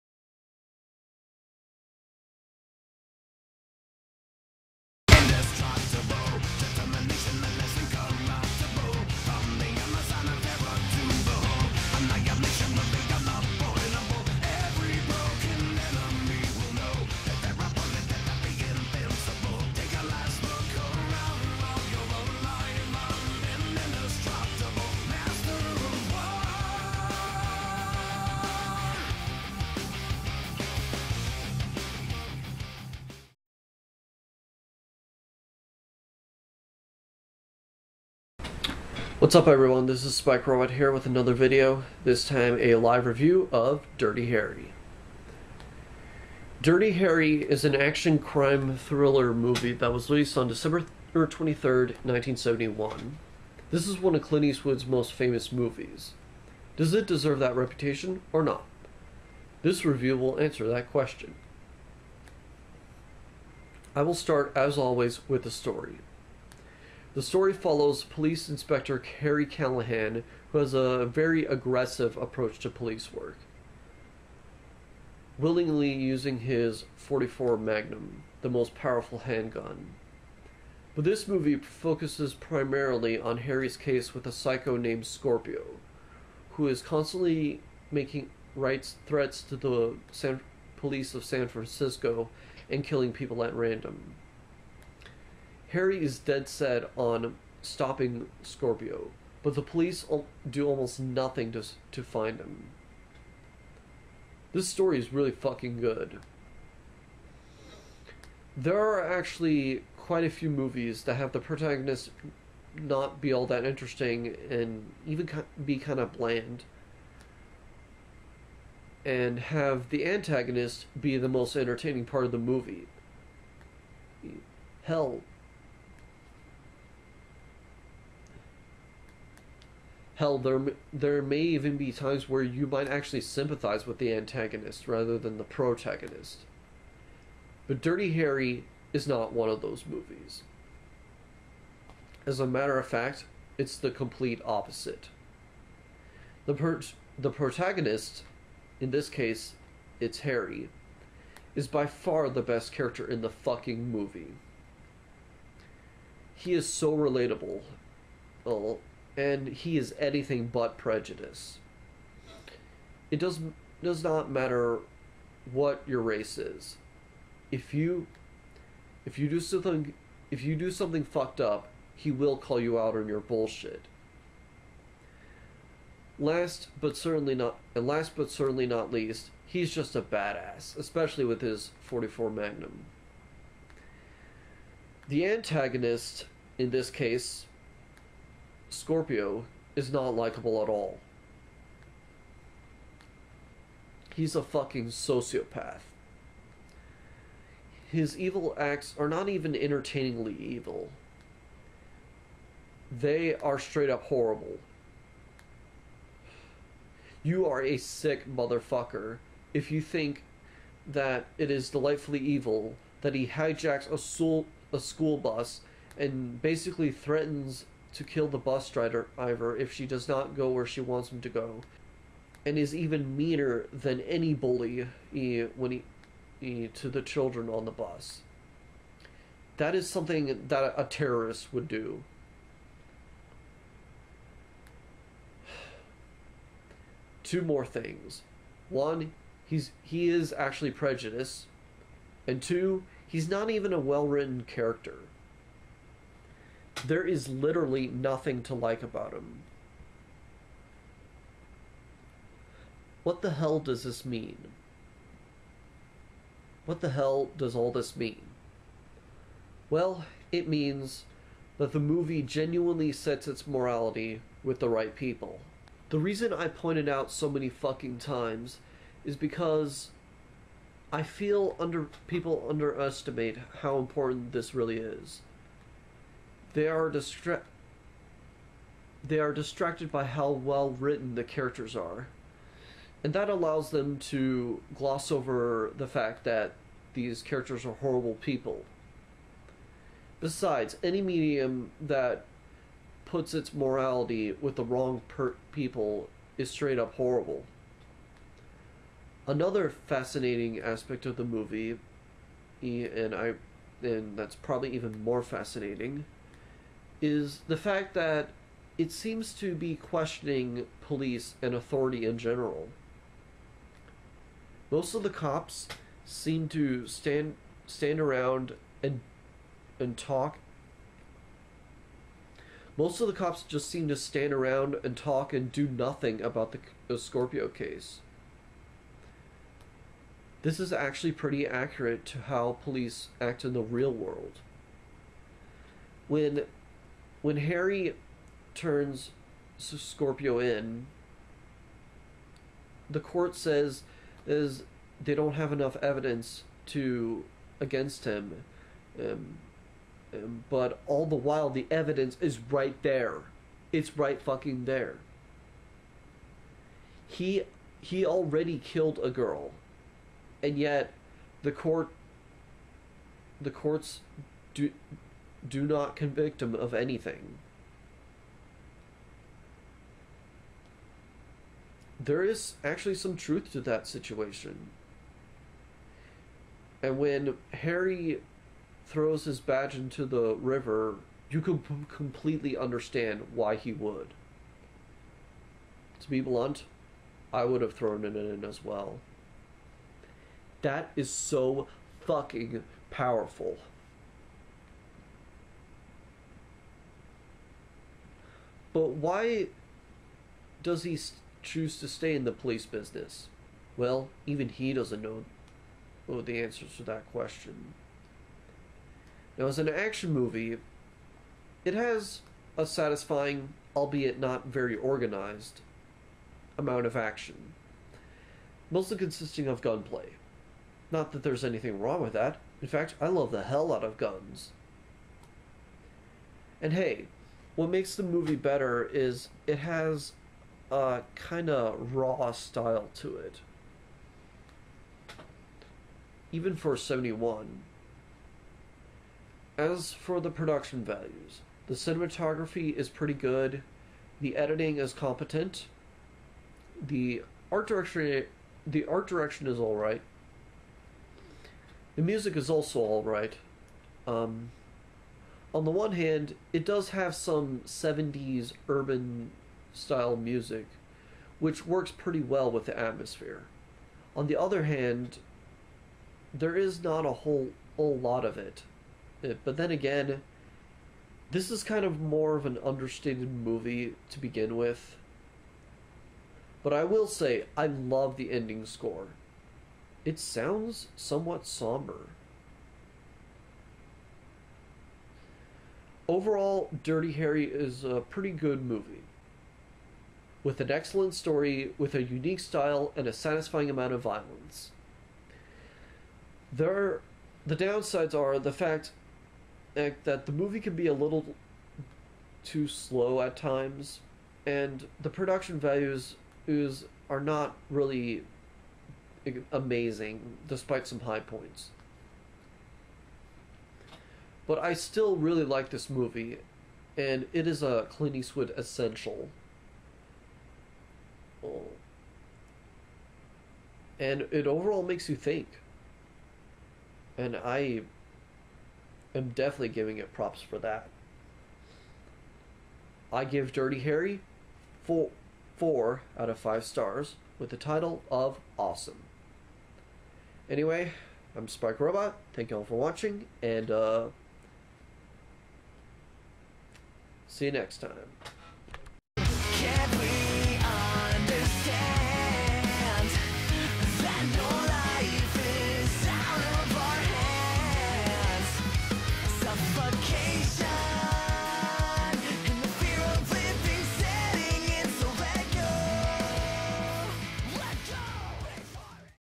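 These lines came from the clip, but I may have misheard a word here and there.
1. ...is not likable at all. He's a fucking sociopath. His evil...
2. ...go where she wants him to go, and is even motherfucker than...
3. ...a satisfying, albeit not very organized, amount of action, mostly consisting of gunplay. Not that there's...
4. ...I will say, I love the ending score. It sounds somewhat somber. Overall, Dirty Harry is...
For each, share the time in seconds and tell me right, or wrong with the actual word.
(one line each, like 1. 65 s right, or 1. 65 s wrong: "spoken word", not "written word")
1. 189 s right
2. 220 s wrong: "meaner", not "motherfucker"
3. 412 s right
4. 476 s right.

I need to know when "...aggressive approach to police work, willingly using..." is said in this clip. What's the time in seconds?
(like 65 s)
71 s.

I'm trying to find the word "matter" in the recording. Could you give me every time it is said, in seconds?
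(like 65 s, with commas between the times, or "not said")
142 s, 164 s.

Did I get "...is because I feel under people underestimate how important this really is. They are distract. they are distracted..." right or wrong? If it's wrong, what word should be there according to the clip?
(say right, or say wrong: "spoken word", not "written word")
right.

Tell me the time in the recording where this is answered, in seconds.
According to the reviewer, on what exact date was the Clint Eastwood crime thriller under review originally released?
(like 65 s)
50 s.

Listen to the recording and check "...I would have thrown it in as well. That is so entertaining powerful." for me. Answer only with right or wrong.
wrong.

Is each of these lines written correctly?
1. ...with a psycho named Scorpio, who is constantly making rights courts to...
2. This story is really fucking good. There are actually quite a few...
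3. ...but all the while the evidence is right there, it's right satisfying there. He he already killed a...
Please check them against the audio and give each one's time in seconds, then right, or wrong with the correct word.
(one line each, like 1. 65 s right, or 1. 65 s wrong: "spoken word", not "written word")
1. 84 s wrong: "threats", not "courts"
2. 104 s right
3. 350 s wrong: "fucking", not "satisfying".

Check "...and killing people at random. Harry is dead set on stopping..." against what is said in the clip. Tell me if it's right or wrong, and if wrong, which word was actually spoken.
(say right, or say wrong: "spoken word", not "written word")
right.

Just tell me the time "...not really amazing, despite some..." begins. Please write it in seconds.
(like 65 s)
507 s.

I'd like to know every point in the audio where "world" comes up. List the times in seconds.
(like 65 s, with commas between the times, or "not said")
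333 s.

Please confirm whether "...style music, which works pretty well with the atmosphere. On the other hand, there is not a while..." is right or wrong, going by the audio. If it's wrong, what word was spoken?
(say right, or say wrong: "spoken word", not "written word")
wrong: "whole", not "while".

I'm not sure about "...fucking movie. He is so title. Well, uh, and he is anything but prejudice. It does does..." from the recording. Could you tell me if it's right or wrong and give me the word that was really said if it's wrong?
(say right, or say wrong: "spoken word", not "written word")
wrong: "relatable", not "title".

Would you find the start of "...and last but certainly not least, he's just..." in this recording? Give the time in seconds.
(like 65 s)
177 s.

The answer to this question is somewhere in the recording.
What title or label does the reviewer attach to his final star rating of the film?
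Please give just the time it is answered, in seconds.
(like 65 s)
538 s.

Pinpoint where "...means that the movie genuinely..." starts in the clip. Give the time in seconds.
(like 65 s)
260 s.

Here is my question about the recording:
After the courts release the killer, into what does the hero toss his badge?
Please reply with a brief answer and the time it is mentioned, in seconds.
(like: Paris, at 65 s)
the river, at 380 s.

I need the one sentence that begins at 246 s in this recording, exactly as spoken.
There is literally nothing to like about him.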